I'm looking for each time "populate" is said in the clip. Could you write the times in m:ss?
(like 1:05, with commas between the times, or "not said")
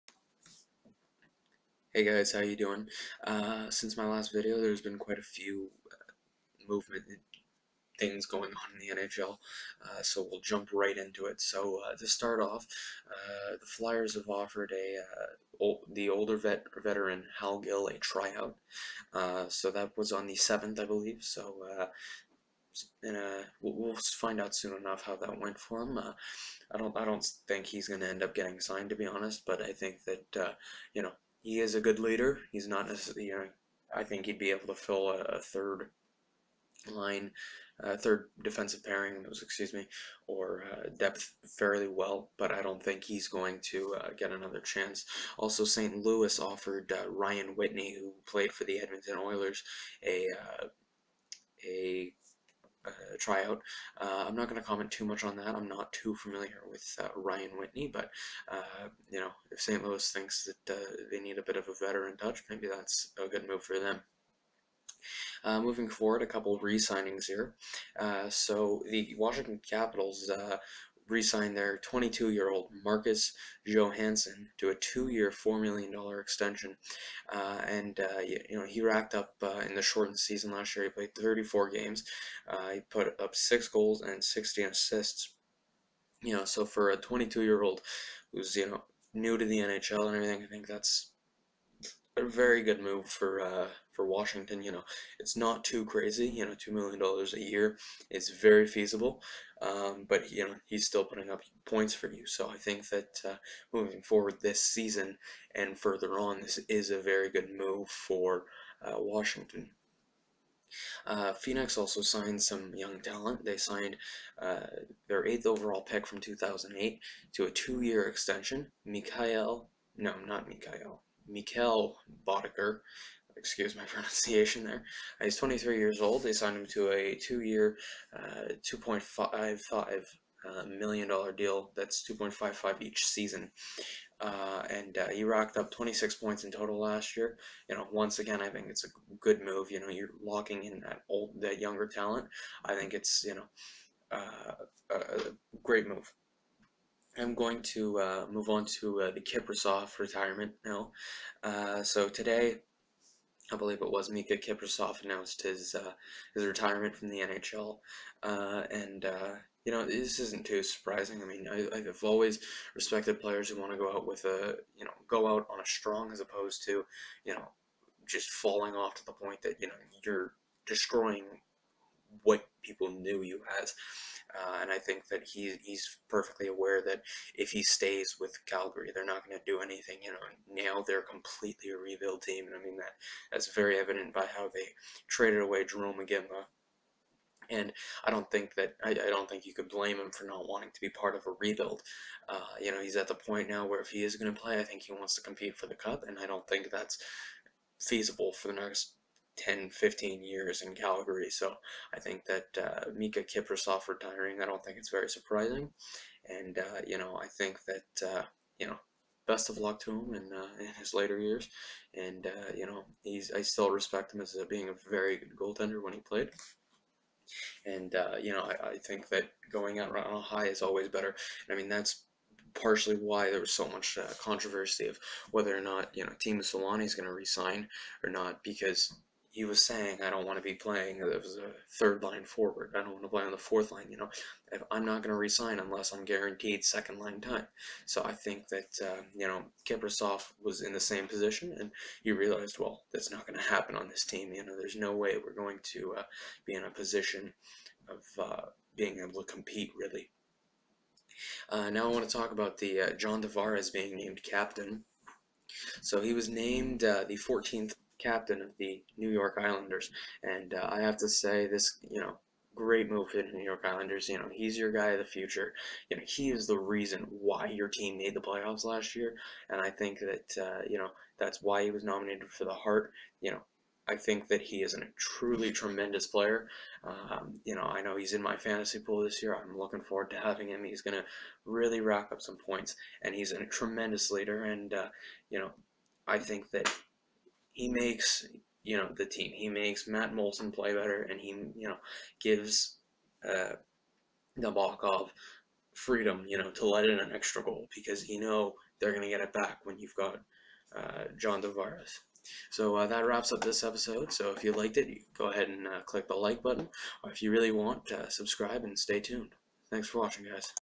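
not said.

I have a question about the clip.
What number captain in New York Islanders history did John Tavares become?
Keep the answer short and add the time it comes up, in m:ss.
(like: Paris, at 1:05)
14th, at 4:17.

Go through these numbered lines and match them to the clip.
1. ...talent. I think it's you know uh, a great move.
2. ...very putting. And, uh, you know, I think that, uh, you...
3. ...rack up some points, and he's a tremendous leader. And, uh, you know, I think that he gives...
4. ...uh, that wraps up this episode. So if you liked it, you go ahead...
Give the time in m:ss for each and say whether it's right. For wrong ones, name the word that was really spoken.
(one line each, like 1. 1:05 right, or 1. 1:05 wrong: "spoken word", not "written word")
1. 2:21 right
2. 3:24 wrong: "surprising", not "putting"
3. 4:41 wrong: "makes", not "gives"
4. 5:02 right.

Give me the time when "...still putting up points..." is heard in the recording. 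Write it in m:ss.
1:40.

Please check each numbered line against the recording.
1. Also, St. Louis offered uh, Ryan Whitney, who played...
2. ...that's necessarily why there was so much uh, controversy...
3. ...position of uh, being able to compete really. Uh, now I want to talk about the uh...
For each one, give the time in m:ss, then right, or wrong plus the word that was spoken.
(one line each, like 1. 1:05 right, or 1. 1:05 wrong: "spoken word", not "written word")
1. 0:45 right
2. 3:41 wrong: "partially", not "necessarily"
3. 4:06 right.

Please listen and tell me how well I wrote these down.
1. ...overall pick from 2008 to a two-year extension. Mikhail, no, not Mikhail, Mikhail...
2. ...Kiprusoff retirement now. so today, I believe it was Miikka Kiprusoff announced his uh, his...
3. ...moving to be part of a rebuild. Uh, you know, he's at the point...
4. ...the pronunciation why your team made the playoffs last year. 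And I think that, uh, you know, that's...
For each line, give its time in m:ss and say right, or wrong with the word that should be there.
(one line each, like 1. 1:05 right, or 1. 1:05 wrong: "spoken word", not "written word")
1. 1:55 right
2. 2:29 right
3. 3:10 wrong: "wanting", not "moving"
4. 4:26 wrong: "reason", not "pronunciation".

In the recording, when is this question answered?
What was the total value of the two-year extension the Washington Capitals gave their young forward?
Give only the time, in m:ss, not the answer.
1:15.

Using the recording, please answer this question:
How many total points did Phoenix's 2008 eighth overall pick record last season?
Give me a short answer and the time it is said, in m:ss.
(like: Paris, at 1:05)
26 points, at 2:15.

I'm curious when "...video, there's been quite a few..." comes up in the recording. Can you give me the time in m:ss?
0:04.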